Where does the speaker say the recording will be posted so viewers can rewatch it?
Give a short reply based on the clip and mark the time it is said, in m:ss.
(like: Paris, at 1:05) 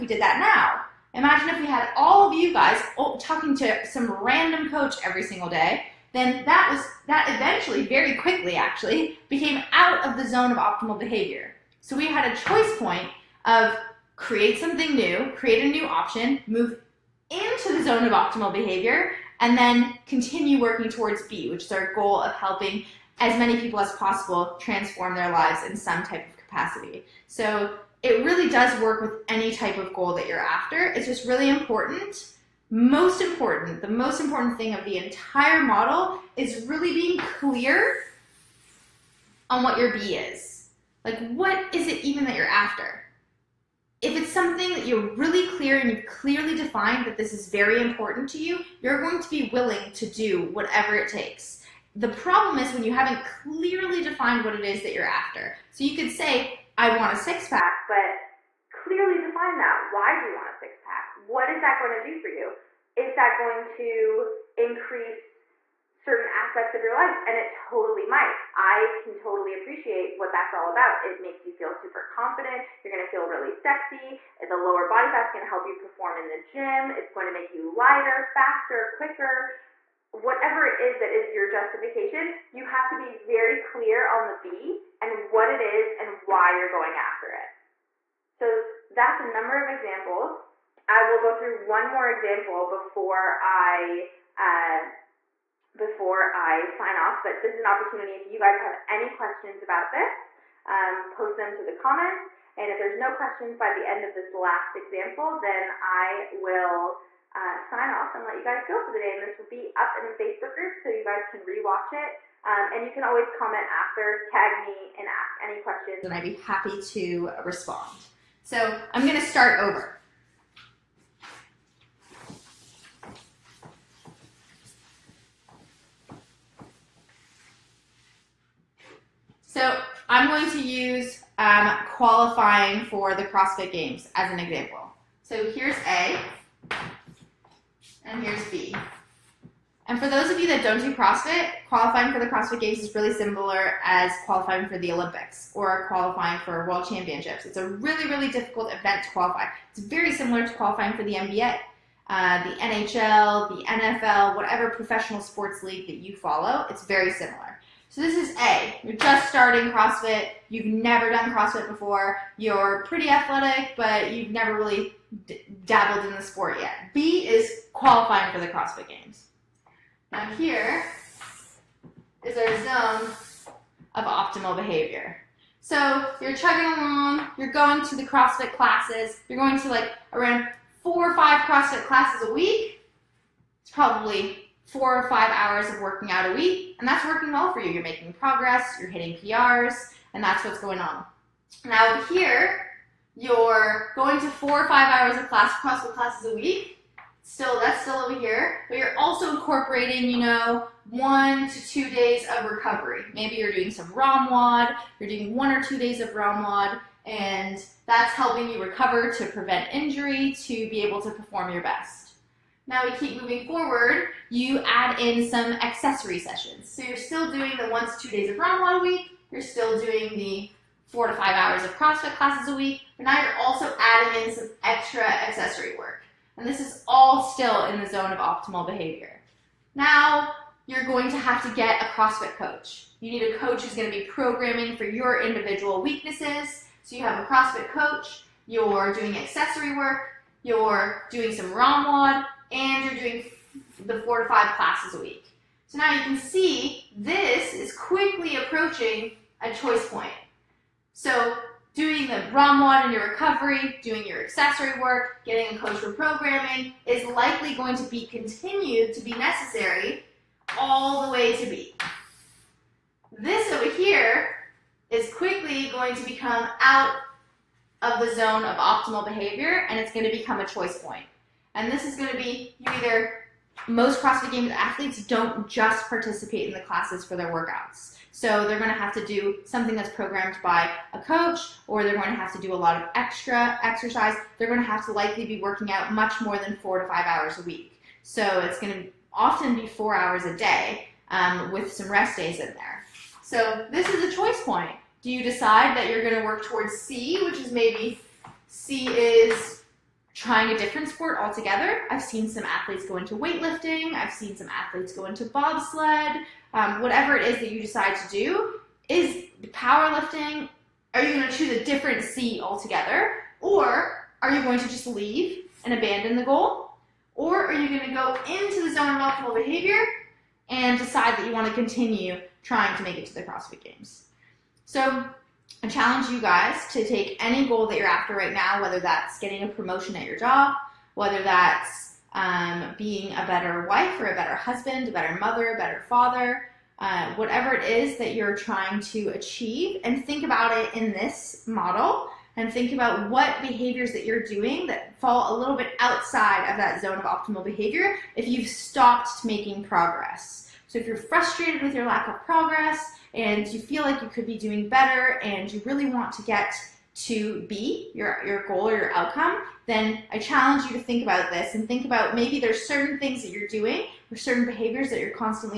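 Facebook group, at 1:50.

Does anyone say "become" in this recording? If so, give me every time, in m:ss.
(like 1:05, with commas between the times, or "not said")
4:26, 4:30.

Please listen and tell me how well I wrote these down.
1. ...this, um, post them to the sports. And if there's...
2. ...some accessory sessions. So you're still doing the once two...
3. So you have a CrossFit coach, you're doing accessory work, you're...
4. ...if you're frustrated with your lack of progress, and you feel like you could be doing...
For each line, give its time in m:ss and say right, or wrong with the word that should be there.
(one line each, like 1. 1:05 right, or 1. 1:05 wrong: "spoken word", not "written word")
1. 1:39 wrong: "comments", not "sports"
2. 3:35 right
3. 3:56 right
4. 5:50 right.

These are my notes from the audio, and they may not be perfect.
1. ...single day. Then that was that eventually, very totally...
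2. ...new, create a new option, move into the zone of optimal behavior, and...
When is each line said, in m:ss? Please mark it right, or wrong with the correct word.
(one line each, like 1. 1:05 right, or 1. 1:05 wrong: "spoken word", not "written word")
1. 0:05 wrong: "quickly", not "totally"
2. 0:14 right.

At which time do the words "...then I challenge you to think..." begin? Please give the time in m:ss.
5:59.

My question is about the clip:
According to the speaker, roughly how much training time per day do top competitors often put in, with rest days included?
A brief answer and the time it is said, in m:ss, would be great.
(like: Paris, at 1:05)
4 hours, at 4:49.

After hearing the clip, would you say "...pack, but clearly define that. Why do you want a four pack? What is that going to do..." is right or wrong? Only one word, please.
wrong.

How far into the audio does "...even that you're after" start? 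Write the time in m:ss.
0:42.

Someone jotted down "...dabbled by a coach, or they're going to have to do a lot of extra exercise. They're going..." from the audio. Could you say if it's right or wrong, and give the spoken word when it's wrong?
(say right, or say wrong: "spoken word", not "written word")
wrong: "programmed", not "dabbled".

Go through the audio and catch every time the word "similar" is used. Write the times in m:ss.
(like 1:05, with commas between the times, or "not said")
2:23, 2:30, 2:37.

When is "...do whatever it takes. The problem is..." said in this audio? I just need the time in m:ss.
0:50.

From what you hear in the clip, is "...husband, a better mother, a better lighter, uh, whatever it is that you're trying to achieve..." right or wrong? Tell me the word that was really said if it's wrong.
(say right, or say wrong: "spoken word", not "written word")
wrong: "father", not "lighter".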